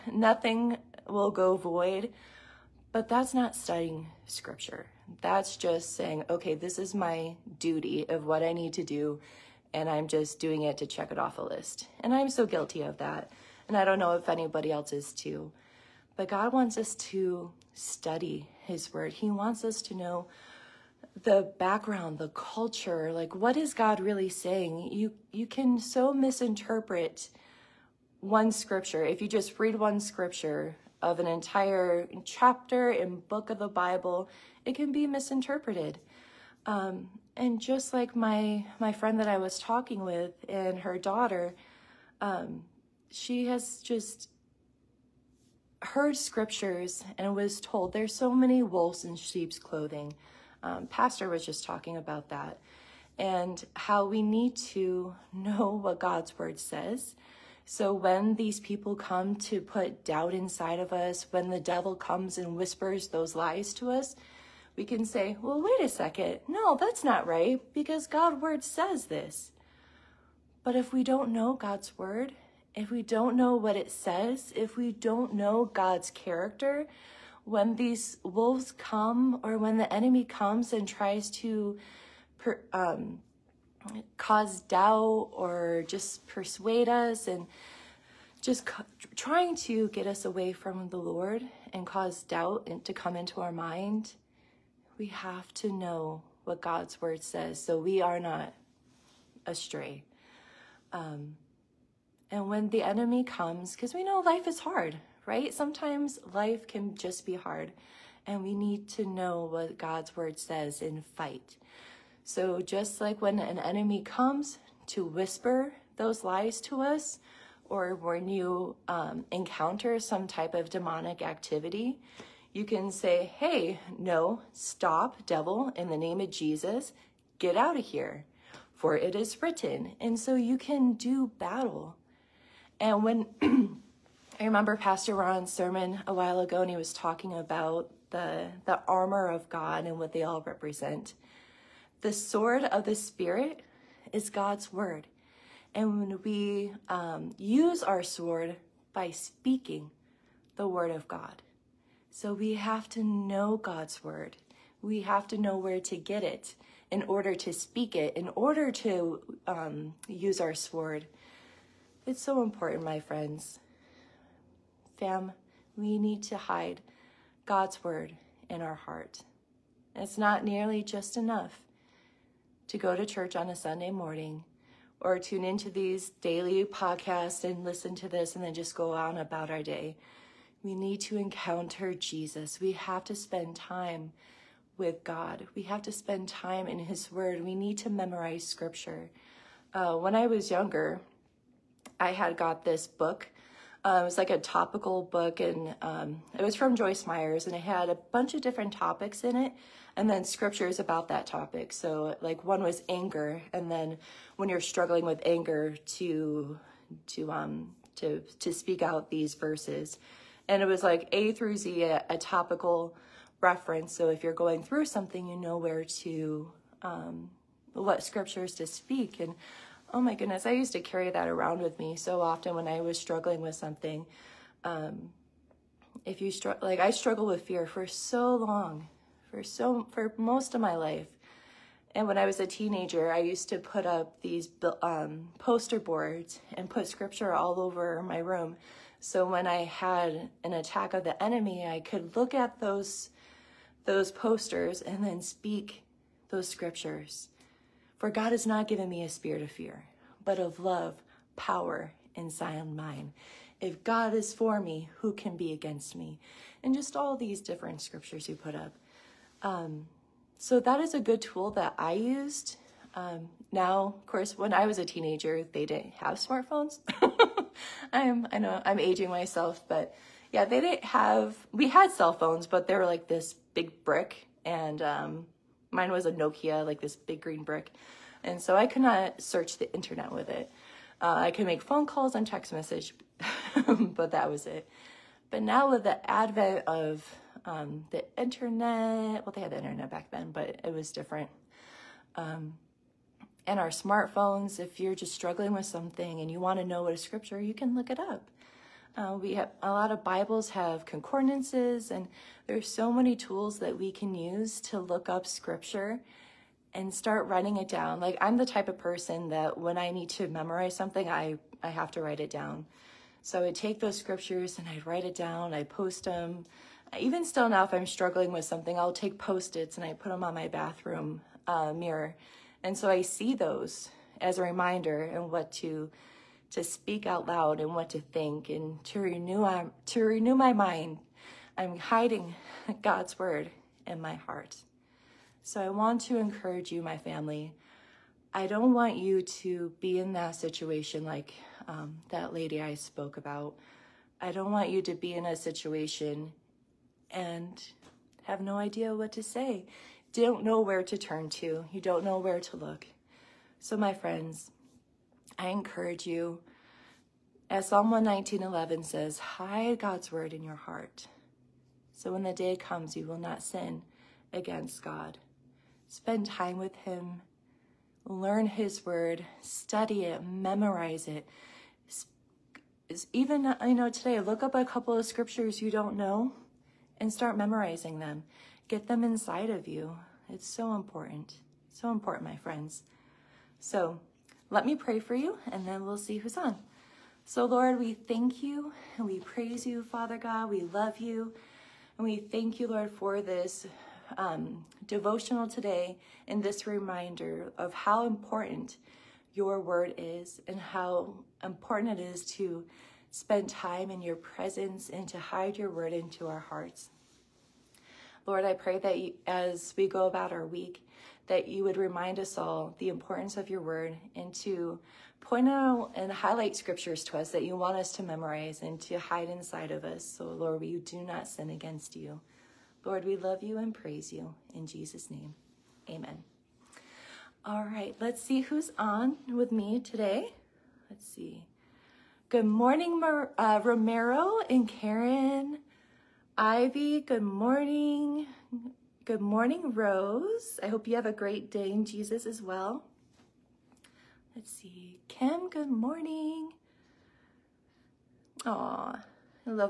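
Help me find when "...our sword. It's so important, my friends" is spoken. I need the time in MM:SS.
02:40.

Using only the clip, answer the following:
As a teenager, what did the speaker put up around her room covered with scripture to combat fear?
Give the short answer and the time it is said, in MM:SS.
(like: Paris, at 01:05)
Poster boards, at 03:55.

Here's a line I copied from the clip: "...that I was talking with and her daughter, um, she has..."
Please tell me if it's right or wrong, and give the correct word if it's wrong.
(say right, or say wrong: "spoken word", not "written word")
right.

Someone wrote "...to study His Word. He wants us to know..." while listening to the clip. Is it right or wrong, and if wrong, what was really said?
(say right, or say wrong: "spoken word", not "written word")
right.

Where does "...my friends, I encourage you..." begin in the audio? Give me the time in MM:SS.
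05:53.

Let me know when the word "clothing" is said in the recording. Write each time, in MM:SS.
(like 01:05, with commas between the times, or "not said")
00:49.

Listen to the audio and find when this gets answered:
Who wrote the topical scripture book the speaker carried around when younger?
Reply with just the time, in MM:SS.
03:16.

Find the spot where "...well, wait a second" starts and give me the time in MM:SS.
01:05.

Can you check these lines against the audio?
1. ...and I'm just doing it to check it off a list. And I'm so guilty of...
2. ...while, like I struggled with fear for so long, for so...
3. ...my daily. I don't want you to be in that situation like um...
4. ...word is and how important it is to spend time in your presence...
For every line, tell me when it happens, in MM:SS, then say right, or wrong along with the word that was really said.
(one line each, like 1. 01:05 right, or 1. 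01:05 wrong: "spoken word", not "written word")
1. 00:09 right
2. 03:46 wrong: "struggle", not "while"
3. 05:36 wrong: "family", not "daily"
4. 06:39 right.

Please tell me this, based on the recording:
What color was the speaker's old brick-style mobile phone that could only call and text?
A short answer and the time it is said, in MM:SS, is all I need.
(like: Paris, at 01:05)
Green, at 04:37.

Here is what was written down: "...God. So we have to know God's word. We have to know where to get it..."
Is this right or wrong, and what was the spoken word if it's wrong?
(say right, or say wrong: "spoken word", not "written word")
right.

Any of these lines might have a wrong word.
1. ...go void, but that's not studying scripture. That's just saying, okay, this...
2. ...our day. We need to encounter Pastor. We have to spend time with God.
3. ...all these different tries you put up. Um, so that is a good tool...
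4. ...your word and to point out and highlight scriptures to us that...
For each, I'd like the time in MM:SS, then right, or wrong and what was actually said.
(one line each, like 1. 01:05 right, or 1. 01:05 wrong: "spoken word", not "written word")
1. 00:01 right
2. 02:59 wrong: "Jesus", not "Pastor"
3. 04:16 wrong: "scriptures", not "tries"
4. 06:53 right.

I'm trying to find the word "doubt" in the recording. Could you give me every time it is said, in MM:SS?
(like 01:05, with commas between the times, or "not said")
01:00, 01:24, 01:32.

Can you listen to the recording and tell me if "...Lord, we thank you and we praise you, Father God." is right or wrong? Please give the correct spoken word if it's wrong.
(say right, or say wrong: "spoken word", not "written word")
right.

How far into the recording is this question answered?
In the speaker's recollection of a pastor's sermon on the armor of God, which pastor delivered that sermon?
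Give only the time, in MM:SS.
02:14.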